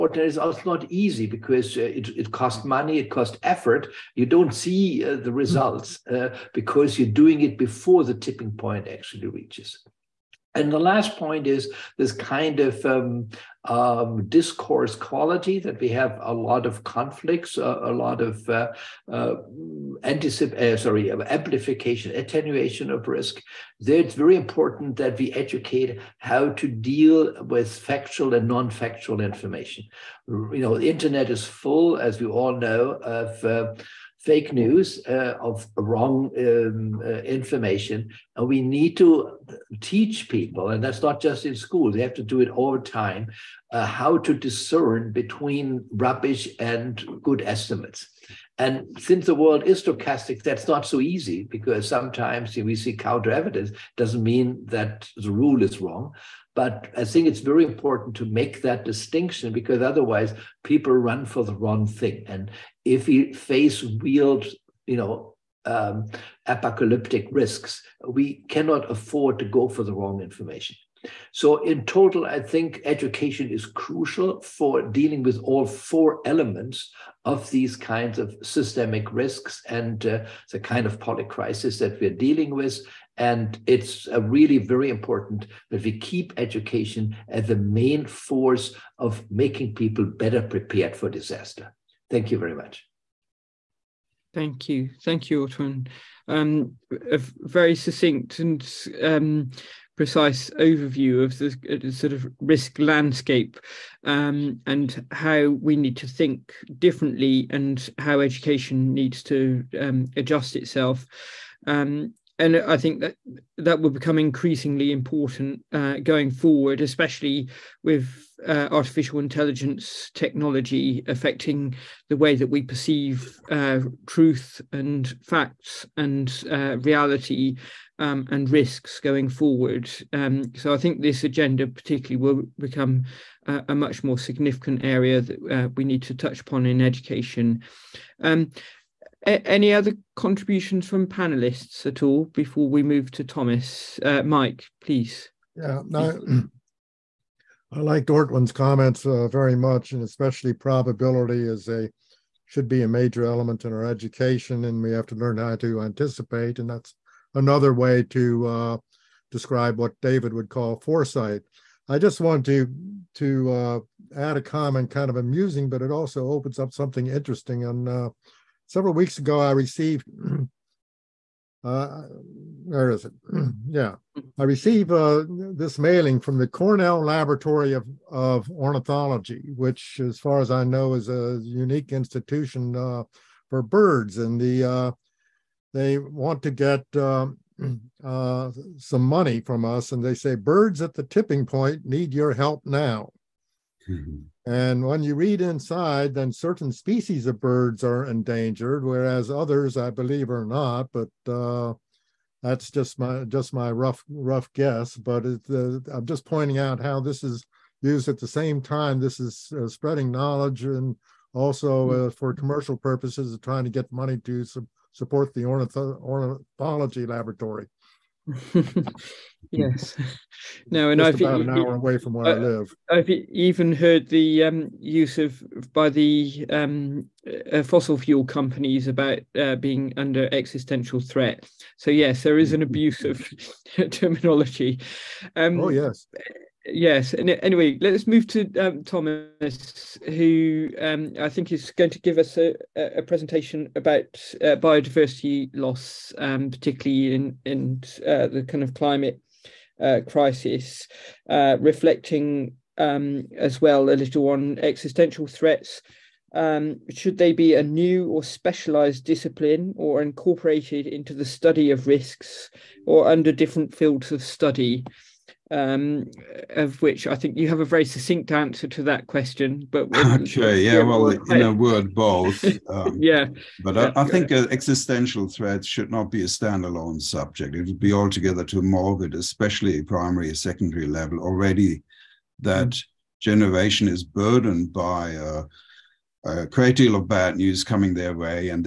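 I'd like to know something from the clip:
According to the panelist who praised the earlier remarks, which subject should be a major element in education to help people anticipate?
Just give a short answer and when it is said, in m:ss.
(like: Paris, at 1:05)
Probability, at 2:30.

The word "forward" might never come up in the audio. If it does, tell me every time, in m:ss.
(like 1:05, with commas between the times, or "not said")
1:56, 2:09.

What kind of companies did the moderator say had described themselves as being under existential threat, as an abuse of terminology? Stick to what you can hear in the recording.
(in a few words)
Fossil fuel companies.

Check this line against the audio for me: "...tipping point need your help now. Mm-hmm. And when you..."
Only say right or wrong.
right.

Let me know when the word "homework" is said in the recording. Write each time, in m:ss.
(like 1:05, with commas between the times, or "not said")
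not said.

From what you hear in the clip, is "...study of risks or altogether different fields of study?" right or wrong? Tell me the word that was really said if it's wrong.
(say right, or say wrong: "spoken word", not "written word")
wrong: "under", not "altogether".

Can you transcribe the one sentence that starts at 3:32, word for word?
for commercial purposes, trying to get money to su support the ornith- ornithology laboratory.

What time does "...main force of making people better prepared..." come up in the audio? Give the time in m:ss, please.
1:27.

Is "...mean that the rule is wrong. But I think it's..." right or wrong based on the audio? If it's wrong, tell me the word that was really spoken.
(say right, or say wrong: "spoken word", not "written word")
right.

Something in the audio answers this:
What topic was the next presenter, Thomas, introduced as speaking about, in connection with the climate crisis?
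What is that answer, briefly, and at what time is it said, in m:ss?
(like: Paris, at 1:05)
Biodiversity loss, at 4:04.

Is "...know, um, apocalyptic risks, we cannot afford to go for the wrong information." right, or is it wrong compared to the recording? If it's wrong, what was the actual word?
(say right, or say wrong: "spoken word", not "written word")
right.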